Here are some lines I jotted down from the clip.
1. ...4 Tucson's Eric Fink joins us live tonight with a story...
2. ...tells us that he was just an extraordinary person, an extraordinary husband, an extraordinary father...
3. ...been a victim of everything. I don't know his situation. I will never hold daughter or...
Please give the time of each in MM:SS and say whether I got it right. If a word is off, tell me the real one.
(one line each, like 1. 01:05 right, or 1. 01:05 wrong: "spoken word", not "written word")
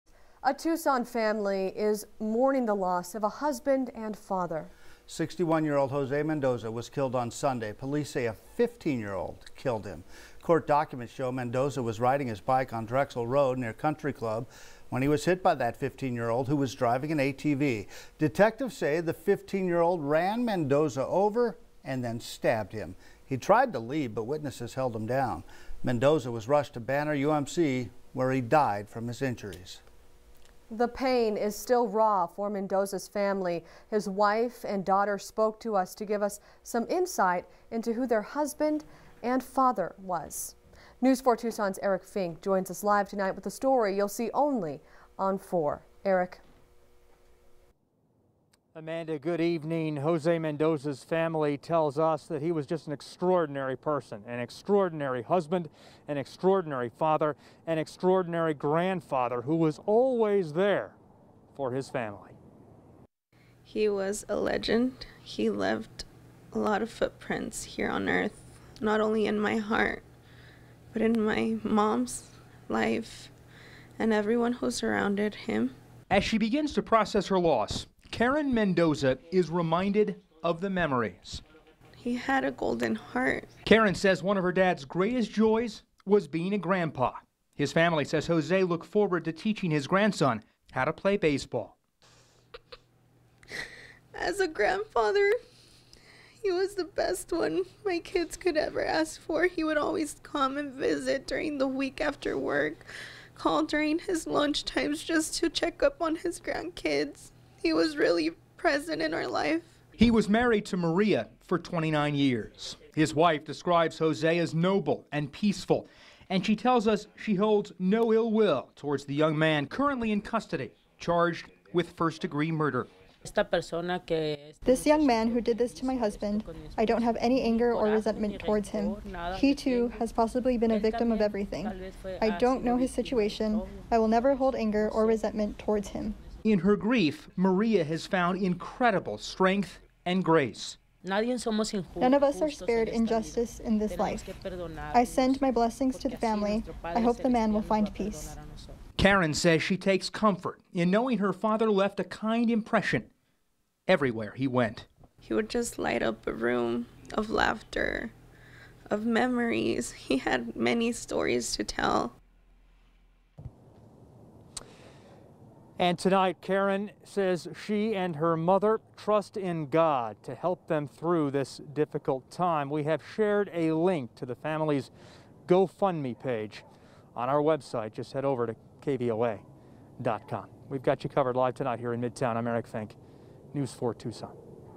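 1. 00:41 right
2. 00:51 right
3. 02:10 wrong: "anger", not "daughter".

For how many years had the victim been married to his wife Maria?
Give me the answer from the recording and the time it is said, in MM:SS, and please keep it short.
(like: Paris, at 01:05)
29, at 01:51.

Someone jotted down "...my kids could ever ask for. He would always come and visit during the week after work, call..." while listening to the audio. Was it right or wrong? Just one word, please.
right.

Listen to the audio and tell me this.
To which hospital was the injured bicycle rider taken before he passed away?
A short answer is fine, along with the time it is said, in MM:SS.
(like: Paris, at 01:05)
Banner UMC, at 00:26.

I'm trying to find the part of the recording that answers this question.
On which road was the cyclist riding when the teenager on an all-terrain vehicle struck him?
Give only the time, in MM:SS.
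00:12.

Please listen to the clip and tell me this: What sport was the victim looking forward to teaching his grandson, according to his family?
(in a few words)
Baseball.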